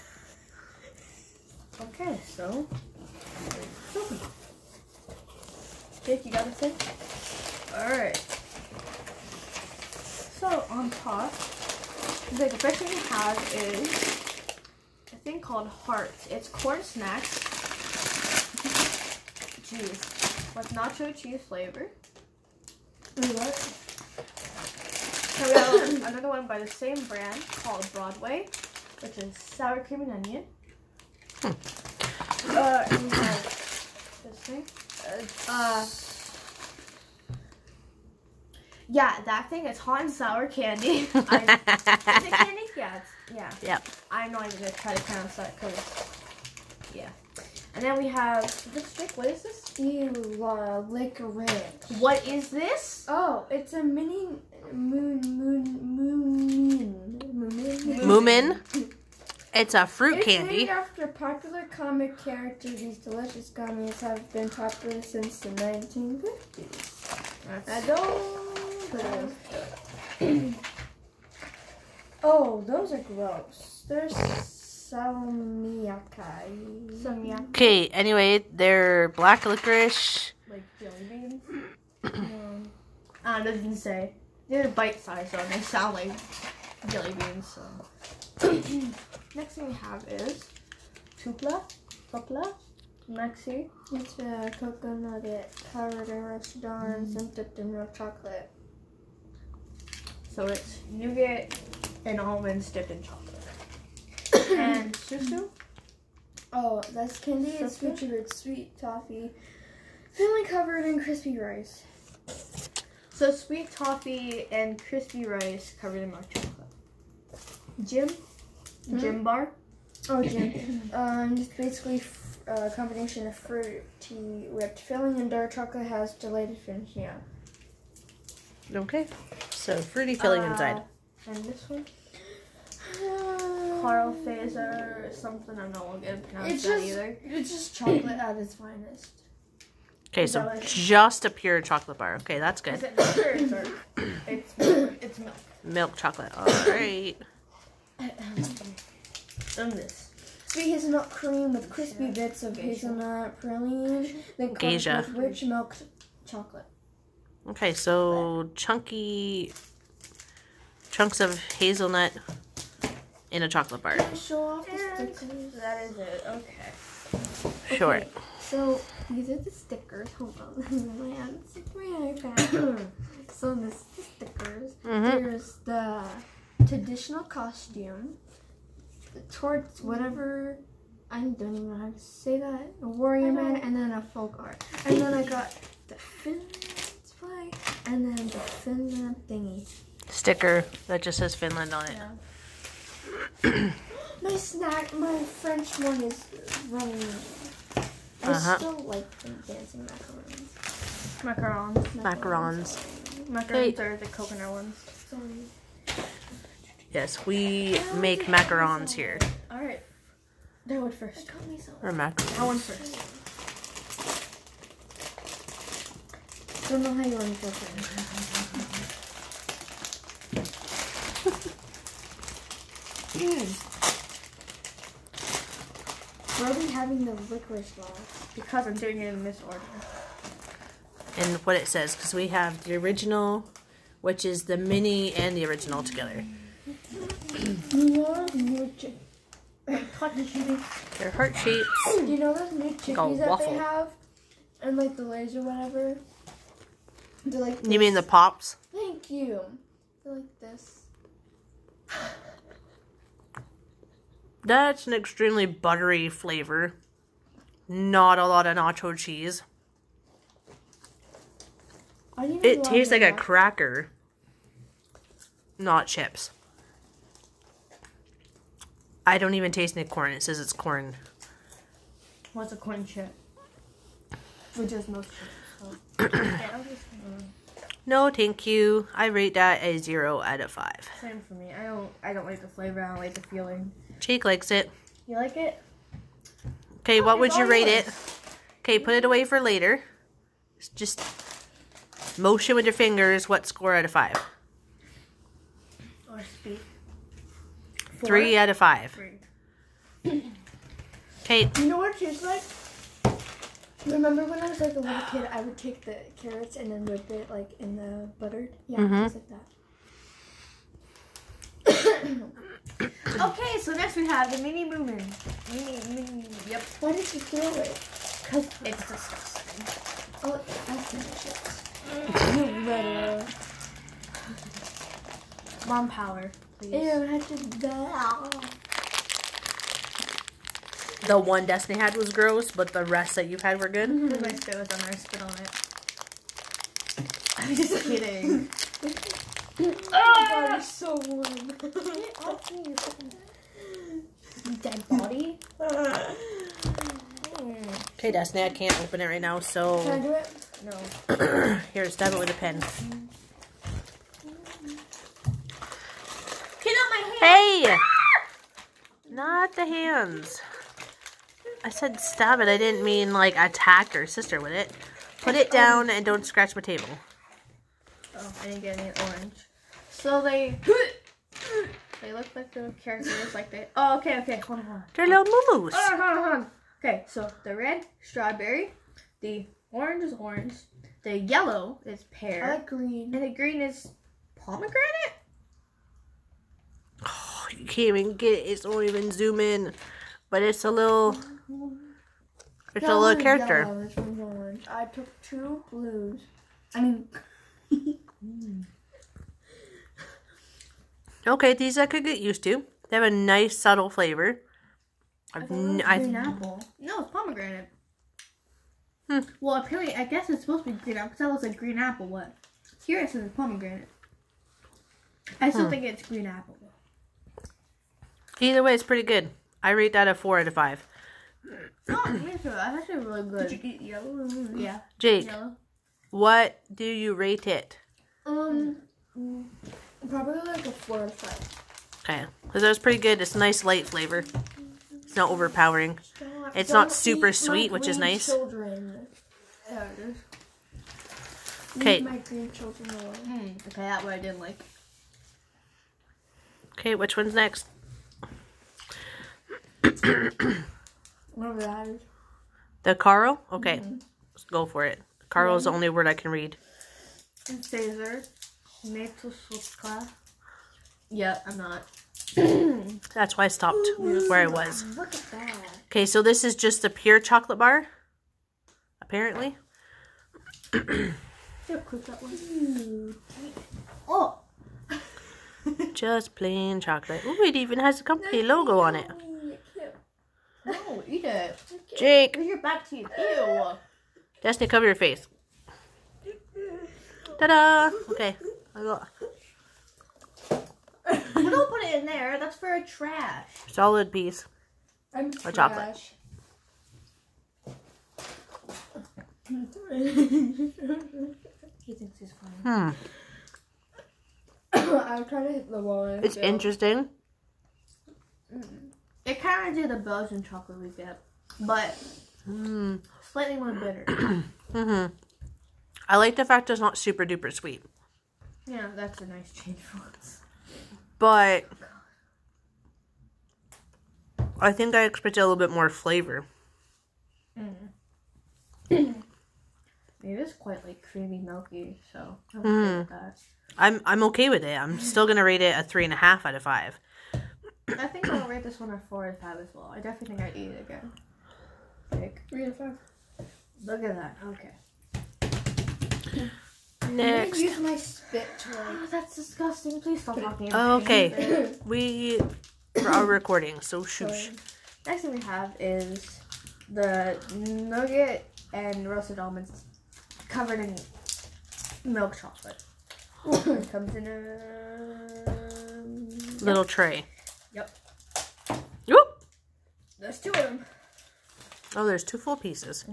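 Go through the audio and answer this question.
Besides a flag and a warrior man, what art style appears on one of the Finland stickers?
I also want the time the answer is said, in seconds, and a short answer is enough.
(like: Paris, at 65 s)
Folk art, at 184 s.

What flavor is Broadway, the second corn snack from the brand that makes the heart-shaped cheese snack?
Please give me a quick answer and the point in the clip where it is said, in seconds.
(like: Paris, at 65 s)
Sour cream and onion, at 29 s.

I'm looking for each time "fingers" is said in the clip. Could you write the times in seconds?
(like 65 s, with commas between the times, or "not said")
292 s.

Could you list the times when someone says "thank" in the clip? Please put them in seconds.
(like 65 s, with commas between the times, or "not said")
248 s, 278 s.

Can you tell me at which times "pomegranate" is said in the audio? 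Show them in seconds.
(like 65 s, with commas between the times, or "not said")
384 s, 407 s, 413 s.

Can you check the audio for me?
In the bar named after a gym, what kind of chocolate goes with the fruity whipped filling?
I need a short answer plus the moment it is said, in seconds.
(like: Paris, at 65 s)
Dark chocolate, at 125 s.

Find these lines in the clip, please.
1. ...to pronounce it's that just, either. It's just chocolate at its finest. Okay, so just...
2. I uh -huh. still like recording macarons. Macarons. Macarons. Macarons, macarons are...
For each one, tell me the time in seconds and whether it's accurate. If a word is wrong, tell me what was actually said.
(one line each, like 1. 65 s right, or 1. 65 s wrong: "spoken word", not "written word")
1. 136 s right
2. 198 s wrong: "dancing", not "recording".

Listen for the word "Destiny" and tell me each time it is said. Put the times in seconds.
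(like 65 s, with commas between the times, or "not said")
331 s, 348 s, 484 s.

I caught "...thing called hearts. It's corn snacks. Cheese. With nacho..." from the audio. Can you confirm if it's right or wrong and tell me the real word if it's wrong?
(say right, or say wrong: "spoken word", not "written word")
right.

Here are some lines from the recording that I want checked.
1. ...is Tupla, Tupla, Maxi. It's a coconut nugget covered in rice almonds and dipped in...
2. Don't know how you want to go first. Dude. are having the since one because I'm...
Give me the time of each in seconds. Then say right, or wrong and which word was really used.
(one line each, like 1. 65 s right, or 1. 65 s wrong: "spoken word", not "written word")
1. 90 s right
2. 216 s wrong: "licorice", not "since".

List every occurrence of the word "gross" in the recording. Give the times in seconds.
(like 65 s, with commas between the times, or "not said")
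72 s, 332 s.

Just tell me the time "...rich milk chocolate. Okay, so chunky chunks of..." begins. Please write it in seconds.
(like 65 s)
155 s.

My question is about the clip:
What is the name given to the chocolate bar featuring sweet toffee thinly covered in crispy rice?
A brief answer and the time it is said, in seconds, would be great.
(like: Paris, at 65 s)
Susu, at 104 s.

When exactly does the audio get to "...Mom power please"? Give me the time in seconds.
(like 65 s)
325 s.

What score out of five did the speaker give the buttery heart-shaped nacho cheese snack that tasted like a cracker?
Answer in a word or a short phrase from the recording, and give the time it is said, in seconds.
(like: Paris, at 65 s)
0, at 279 s.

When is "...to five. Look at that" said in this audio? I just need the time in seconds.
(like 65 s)
542 s.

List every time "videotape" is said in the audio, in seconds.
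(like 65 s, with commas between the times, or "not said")
not said.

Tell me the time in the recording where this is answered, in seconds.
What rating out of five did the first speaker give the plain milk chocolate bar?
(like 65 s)
535 s.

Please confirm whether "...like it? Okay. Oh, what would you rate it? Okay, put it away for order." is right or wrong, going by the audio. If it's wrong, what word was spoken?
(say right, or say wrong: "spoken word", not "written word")
wrong: "later", not "order".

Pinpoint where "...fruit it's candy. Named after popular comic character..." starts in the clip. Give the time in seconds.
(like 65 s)
59 s.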